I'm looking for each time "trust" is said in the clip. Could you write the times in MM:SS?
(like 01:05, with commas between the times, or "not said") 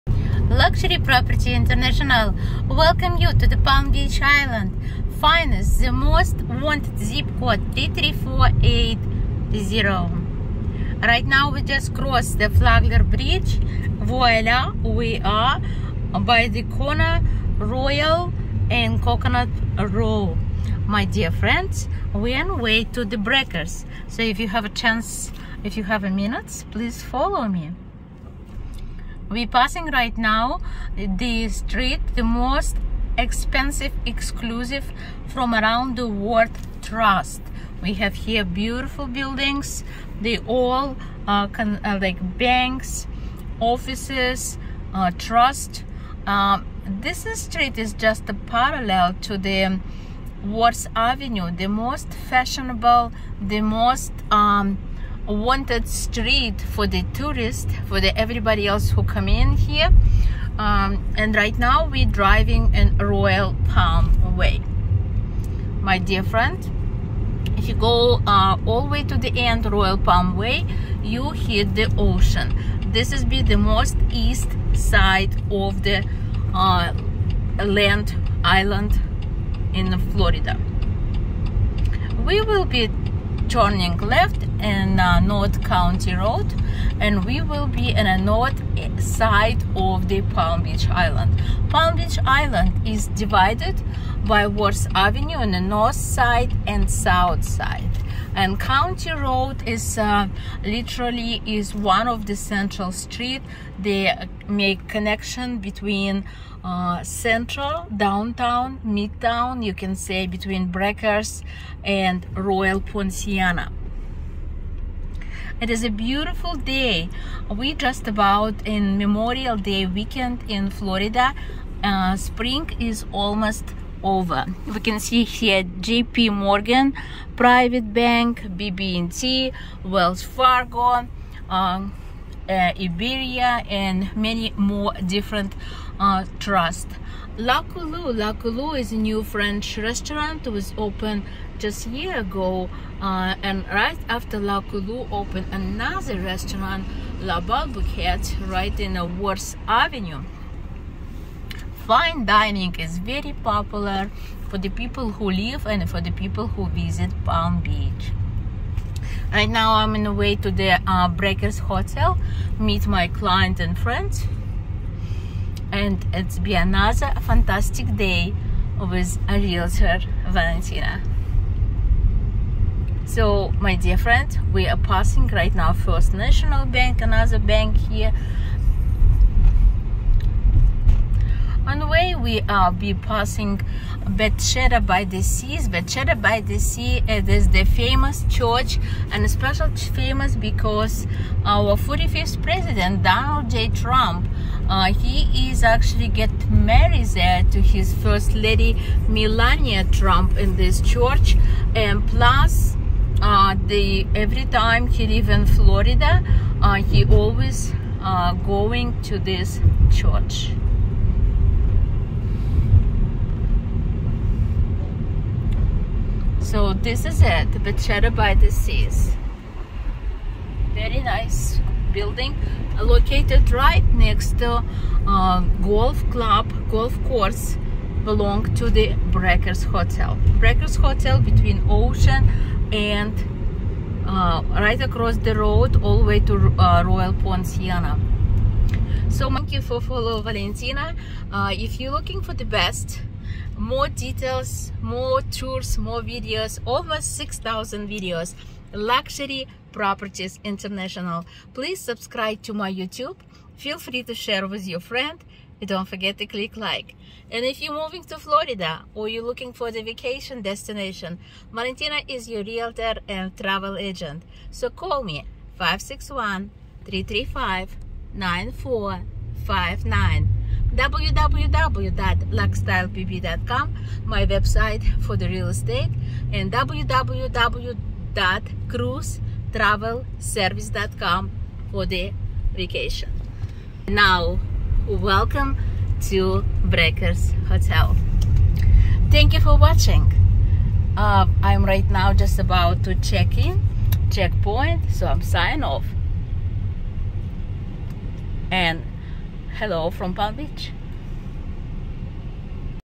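00:36, 00:45, 02:16.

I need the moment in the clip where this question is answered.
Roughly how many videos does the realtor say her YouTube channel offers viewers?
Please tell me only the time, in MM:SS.
04:06.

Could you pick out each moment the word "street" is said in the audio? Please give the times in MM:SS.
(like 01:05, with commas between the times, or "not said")
00:31, 00:47, 00:55, 01:42.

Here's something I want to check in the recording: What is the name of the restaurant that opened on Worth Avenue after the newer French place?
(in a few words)
La Bilboquet.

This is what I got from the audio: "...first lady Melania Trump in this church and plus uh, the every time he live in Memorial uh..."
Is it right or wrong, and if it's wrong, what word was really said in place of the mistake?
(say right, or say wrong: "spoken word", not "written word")
wrong: "Florida", not "Memorial".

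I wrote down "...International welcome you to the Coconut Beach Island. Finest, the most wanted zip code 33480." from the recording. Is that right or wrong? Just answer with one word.
wrong.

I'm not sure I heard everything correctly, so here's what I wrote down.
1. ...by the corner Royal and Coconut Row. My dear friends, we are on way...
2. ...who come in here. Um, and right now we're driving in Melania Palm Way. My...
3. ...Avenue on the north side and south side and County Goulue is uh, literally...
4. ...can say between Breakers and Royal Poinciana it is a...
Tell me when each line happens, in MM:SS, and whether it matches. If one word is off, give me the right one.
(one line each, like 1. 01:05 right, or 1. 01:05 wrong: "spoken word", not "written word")
1. 00:16 right
2. 00:58 wrong: "Royal", not "Melania"
3. 01:34 wrong: "Road", not "Goulue"
4. 01:49 right.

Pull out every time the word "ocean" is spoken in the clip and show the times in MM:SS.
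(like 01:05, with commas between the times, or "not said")
01:11, 03:51.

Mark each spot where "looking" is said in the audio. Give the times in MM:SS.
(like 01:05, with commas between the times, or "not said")
04:01, 04:19.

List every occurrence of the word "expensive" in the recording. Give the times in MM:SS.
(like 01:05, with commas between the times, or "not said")
00:33.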